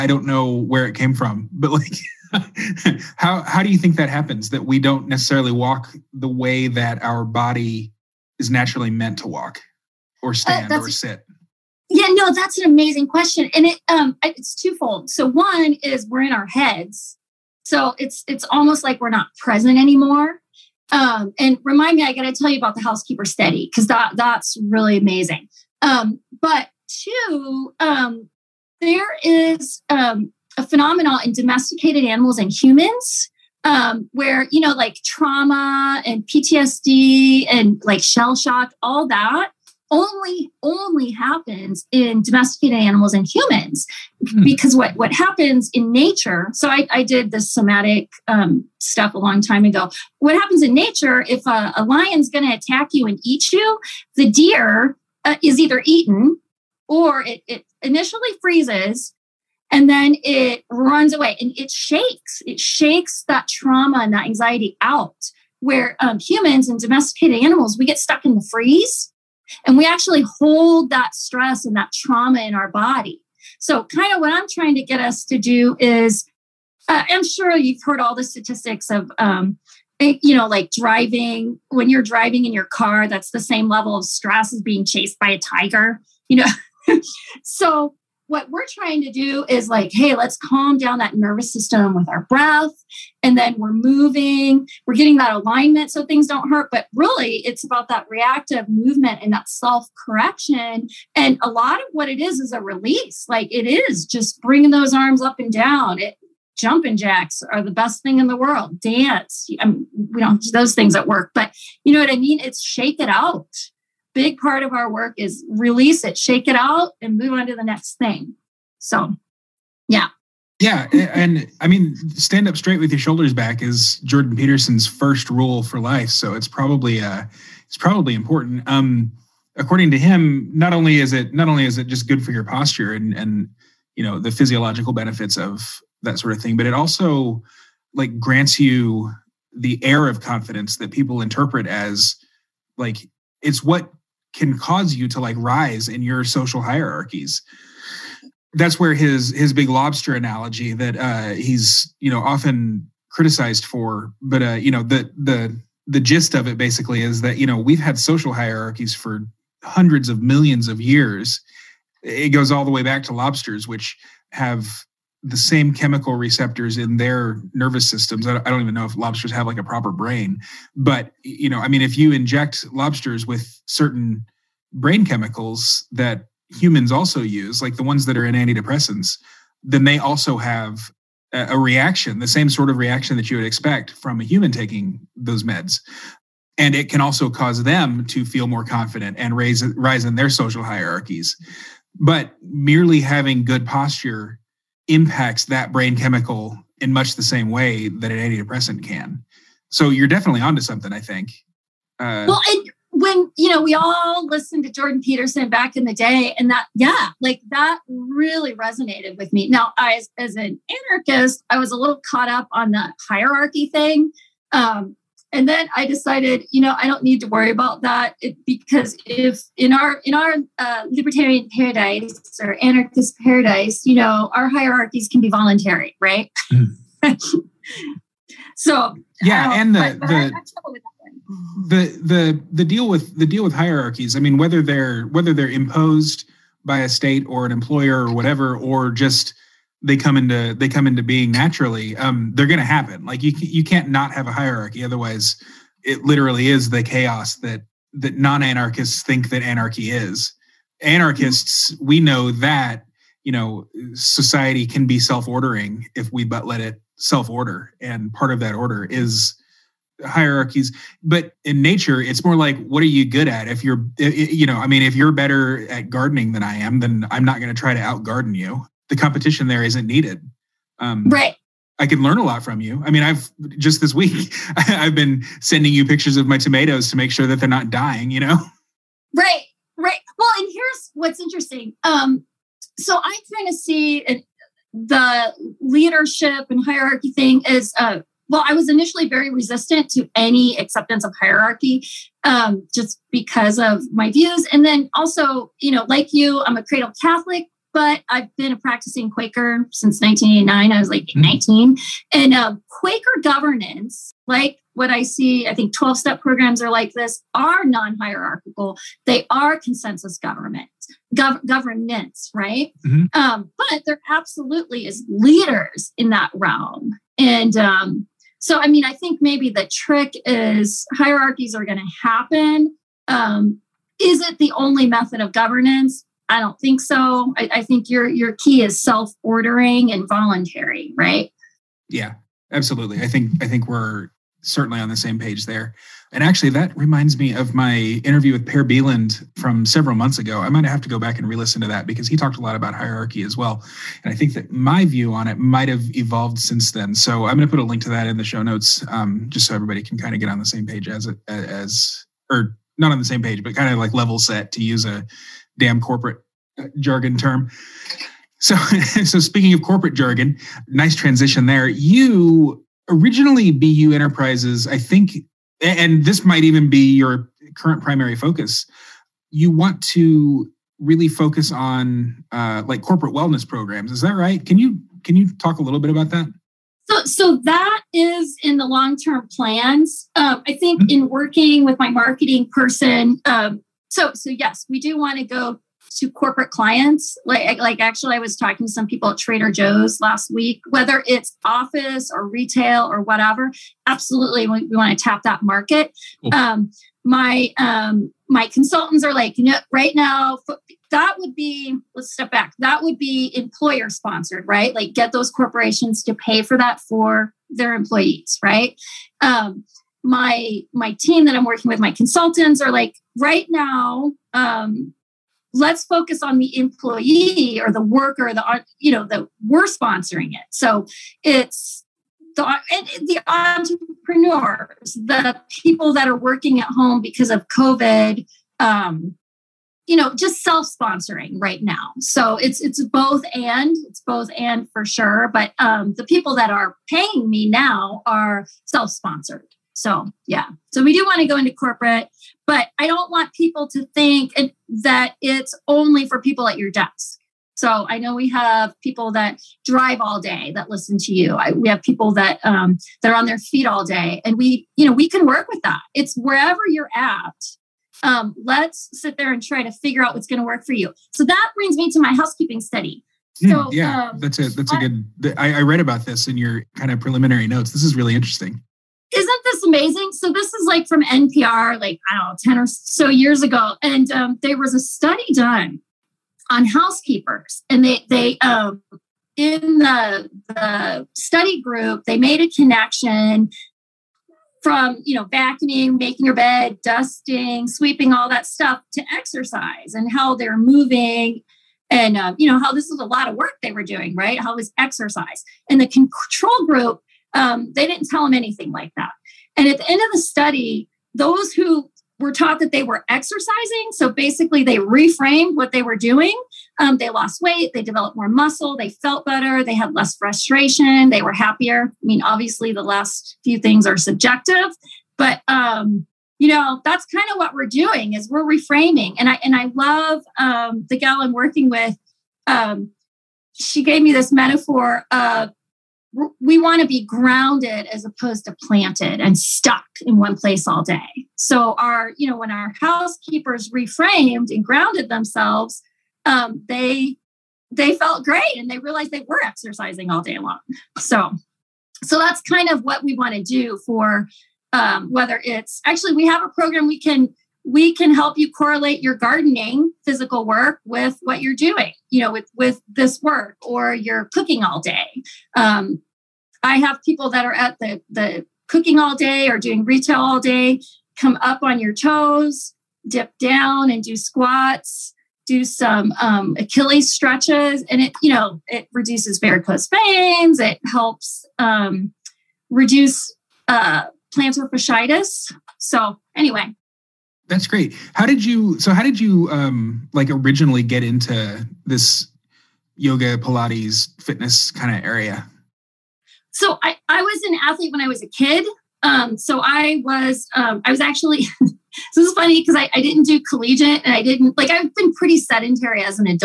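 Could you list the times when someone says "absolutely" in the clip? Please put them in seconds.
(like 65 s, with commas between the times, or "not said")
314 s, 332 s, 393 s.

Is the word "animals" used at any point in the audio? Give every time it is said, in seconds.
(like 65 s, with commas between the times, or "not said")
32 s, 42 s, 67 s.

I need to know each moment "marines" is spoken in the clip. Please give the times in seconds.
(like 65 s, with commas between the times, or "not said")
not said.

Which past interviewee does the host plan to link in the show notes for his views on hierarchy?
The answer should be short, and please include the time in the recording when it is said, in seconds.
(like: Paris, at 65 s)
Per Bylund, at 338 s.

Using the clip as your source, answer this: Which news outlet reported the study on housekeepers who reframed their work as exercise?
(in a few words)
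NPR.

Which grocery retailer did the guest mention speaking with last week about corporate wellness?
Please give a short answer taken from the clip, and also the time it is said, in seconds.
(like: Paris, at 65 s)
Trader Joe's, at 389 s.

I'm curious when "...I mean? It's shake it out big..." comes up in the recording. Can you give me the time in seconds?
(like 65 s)
112 s.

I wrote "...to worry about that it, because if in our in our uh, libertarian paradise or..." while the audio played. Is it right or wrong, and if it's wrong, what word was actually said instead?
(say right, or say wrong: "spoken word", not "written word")
right.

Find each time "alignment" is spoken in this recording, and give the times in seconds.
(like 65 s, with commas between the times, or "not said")
95 s.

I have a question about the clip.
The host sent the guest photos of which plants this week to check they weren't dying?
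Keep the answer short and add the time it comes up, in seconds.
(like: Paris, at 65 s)
Tomatoes, at 276 s.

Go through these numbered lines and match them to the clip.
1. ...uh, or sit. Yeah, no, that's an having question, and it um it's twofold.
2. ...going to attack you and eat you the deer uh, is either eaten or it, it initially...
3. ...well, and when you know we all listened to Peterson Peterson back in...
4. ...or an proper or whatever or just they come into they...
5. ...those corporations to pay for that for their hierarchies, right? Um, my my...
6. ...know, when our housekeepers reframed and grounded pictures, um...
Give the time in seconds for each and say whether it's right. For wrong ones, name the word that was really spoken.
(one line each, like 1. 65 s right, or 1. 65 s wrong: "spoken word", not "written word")
1. 10 s wrong: "amazing", not "having"
2. 52 s right
3. 202 s wrong: "Jordan", not "Peterson"
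4. 237 s wrong: "employer", not "proper"
5. 405 s wrong: "employees", not "hierarchies"
6. 532 s wrong: "themselves", not "pictures".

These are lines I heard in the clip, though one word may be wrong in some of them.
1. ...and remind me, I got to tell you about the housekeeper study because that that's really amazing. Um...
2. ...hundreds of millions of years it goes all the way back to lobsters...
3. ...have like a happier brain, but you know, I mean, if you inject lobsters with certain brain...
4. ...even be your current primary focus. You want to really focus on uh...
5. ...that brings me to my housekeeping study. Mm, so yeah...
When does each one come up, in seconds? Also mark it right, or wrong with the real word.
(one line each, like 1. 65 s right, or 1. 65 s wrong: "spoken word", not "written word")
1. 21 s right
2. 159 s right
3. 169 s wrong: "proper", not "happier"
4. 366 s right
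5. 461 s right.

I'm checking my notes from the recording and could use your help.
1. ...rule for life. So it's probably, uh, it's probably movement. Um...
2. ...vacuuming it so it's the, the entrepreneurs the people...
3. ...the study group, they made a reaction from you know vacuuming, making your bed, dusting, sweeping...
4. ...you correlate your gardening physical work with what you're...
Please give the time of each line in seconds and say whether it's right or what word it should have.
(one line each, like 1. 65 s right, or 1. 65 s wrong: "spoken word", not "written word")
1. 125 s wrong: "important", not "movement"
2. 419 s wrong: "sponsoring", not "vacuuming"
3. 480 s wrong: "connection", not "reaction"
4. 548 s right.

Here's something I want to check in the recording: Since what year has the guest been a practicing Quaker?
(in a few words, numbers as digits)
1989.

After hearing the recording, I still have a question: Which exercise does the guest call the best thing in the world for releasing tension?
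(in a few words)
Jumping jacks.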